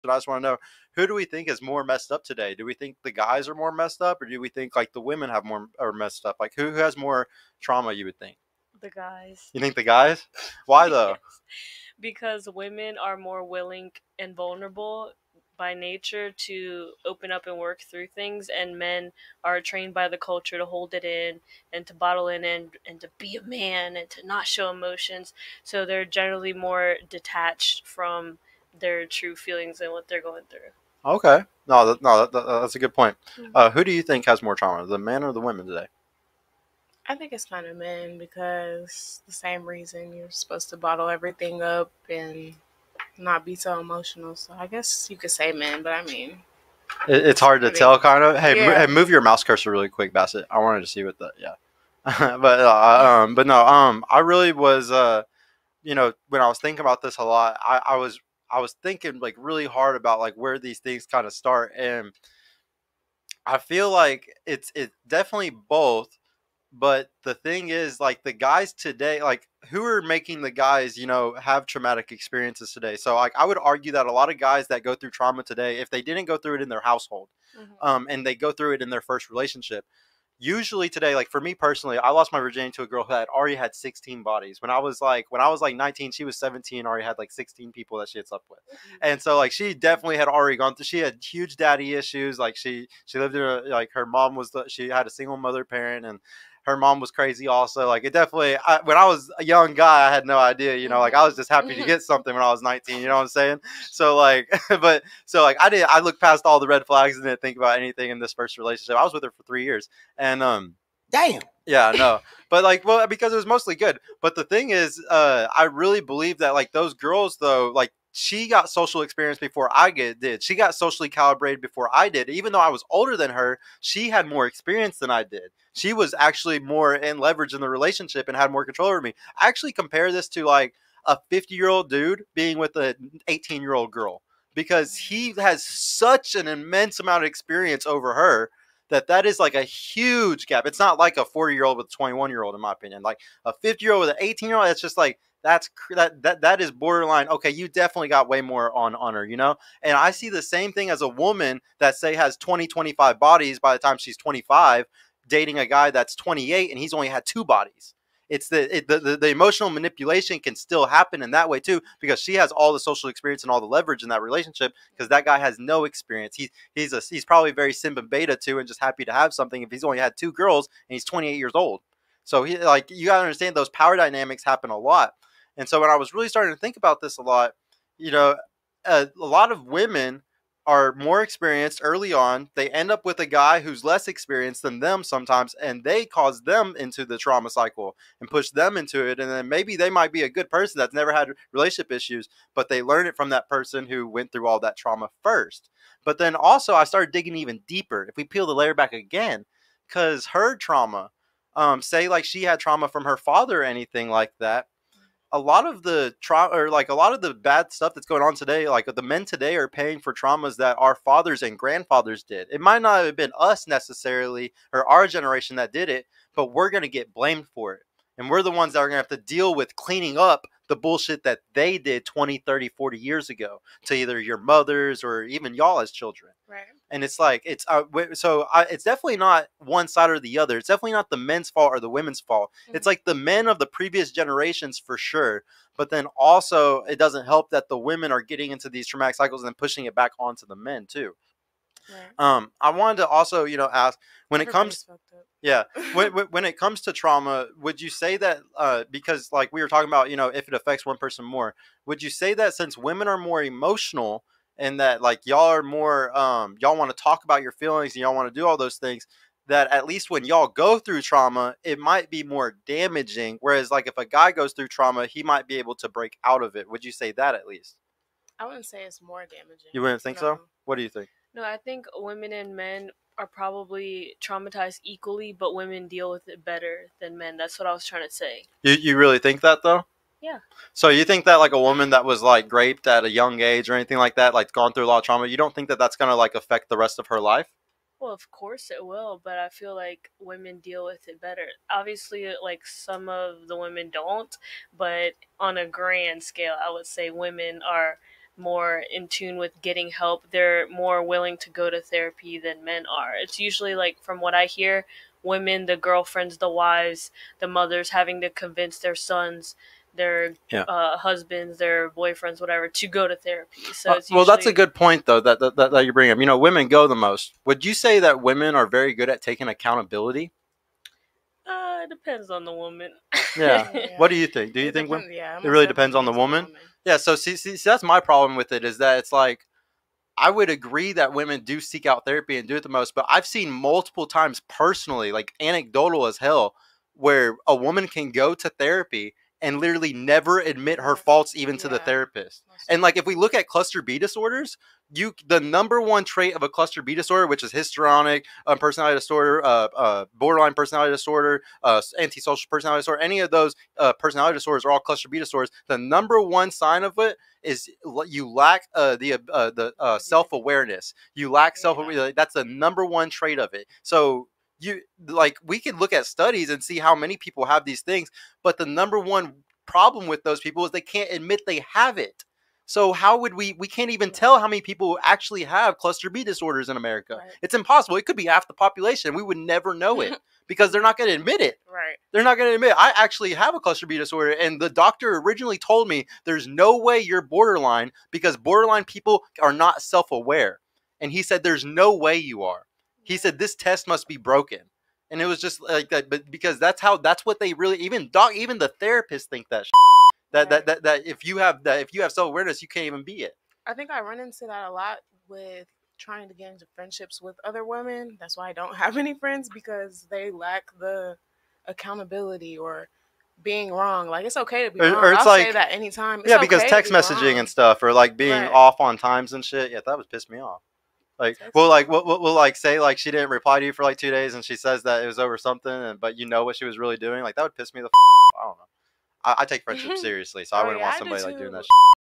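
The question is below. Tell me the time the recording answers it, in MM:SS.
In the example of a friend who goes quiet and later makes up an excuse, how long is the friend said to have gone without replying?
07:03.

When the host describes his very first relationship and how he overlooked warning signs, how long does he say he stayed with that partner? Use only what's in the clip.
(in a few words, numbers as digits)
3 years.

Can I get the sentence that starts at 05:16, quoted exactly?
You know, women go the most.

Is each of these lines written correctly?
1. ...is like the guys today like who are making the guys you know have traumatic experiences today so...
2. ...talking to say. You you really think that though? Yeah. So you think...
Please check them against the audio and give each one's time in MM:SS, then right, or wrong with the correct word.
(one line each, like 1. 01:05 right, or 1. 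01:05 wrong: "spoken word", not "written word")
1. 01:07 right
2. 04:37 wrong: "trying", not "talking".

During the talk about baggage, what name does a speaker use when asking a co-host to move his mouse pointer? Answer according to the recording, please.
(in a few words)
Bassett.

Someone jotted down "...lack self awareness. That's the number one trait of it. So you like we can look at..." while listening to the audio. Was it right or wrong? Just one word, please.
right.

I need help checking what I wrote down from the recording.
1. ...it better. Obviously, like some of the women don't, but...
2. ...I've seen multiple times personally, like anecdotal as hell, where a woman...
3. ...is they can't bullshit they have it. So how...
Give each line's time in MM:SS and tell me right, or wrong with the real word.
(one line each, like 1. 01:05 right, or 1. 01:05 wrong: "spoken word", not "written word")
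1. 04:51 right
2. 05:33 right
3. 06:10 wrong: "admit", not "bullshit".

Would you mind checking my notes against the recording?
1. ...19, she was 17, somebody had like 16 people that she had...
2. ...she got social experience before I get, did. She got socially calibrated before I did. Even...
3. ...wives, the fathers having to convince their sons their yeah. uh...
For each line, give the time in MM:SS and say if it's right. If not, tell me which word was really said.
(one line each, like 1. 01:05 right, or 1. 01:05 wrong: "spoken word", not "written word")
1. 01:25 wrong: "already", not "somebody"
2. 01:58 right
3. 05:06 wrong: "mothers", not "fathers".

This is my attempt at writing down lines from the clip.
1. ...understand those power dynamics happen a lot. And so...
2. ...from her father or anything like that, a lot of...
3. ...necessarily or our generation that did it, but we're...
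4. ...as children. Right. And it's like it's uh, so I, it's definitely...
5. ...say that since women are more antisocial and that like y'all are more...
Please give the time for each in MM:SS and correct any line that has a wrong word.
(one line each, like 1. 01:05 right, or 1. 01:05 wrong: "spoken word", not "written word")
1. 02:53 right
2. 03:22 right
3. 03:33 right
4. 03:45 right
5. 04:12 wrong: "emotional", not "antisocial".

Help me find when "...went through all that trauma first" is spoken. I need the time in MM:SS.
03:14.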